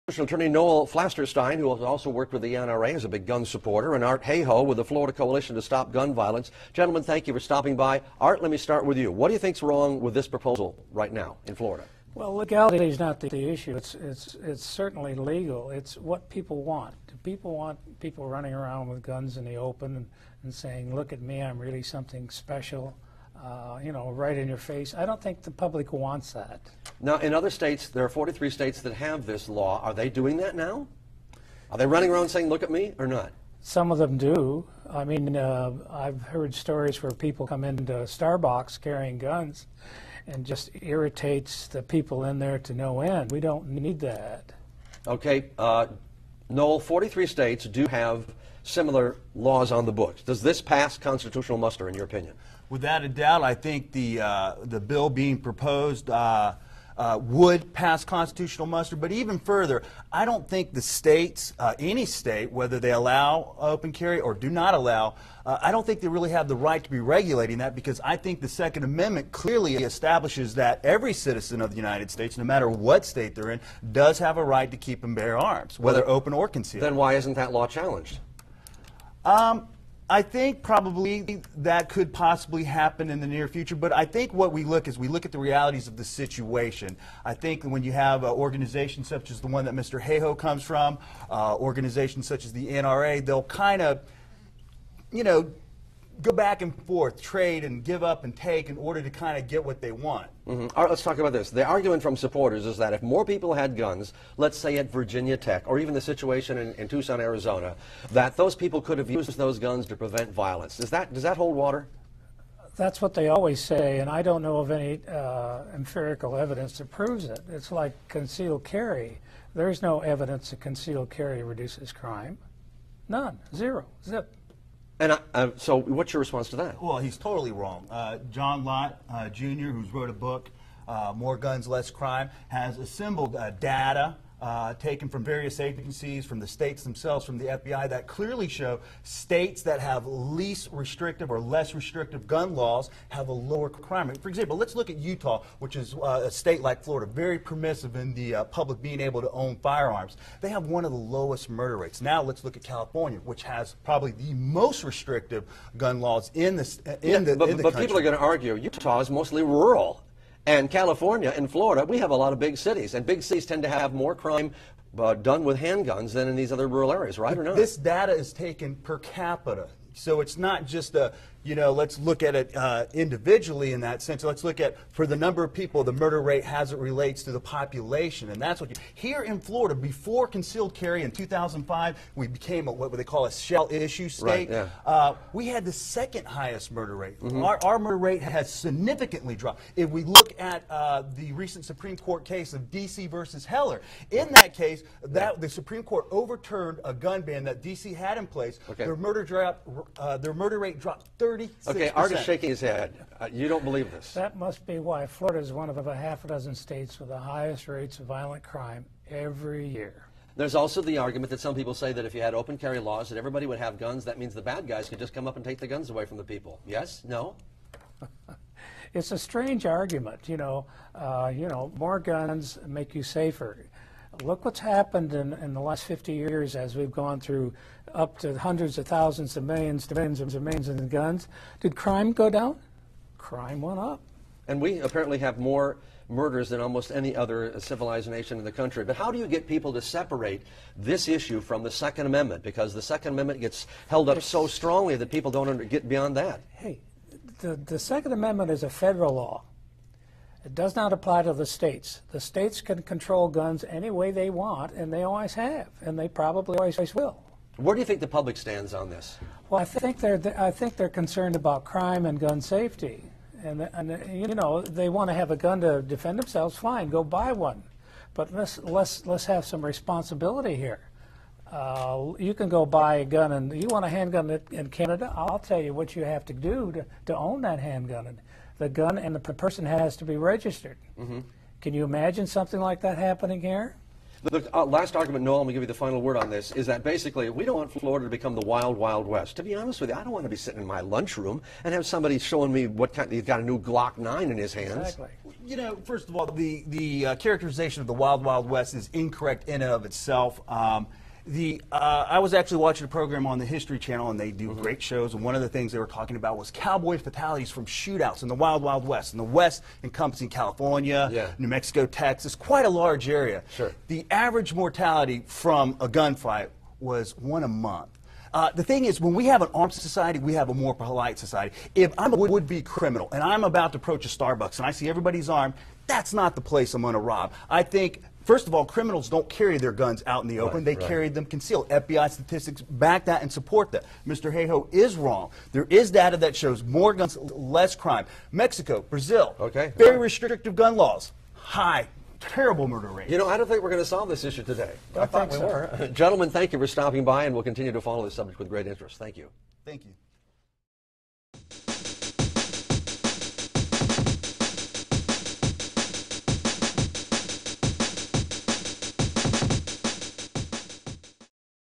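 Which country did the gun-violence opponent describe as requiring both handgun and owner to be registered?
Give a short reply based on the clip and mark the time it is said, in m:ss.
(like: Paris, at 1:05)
Canada, at 4:34.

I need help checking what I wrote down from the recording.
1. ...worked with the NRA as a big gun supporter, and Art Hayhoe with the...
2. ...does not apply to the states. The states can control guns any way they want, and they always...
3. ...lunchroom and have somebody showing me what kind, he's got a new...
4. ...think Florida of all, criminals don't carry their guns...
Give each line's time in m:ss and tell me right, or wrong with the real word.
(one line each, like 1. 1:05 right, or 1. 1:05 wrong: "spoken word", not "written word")
1. 0:02 right
2. 4:10 right
3. 4:50 right
4. 5:27 wrong: "First", not "Florida".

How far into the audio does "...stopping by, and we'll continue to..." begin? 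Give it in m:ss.
5:46.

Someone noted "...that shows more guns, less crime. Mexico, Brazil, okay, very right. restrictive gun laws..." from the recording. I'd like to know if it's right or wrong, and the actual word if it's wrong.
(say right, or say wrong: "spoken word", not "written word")
right.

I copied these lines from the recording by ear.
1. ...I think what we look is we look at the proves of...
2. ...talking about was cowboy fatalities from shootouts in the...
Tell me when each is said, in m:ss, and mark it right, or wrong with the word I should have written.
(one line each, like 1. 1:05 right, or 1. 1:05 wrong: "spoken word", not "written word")
1. 1:23 wrong: "realities", not "proves"
2. 5:05 right.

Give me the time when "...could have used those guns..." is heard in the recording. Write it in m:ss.
1:48.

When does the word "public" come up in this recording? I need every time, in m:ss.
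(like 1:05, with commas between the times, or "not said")
0:25, 2:28, 4:18.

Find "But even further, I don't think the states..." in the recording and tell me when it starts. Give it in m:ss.
0:58.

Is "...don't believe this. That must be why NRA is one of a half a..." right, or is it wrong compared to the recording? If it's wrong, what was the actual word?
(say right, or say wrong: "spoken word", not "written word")
wrong: "Florida", not "NRA".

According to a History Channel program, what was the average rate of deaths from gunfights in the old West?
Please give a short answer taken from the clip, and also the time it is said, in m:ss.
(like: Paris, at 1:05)
one a month, at 5:17.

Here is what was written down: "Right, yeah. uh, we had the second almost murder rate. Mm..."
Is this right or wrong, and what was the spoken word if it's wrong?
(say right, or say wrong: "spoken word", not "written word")
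wrong: "highest", not "almost".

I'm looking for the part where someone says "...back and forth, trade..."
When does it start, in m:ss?
1:36.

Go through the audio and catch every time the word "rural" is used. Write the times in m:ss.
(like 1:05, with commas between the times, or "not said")
2:39, 2:46.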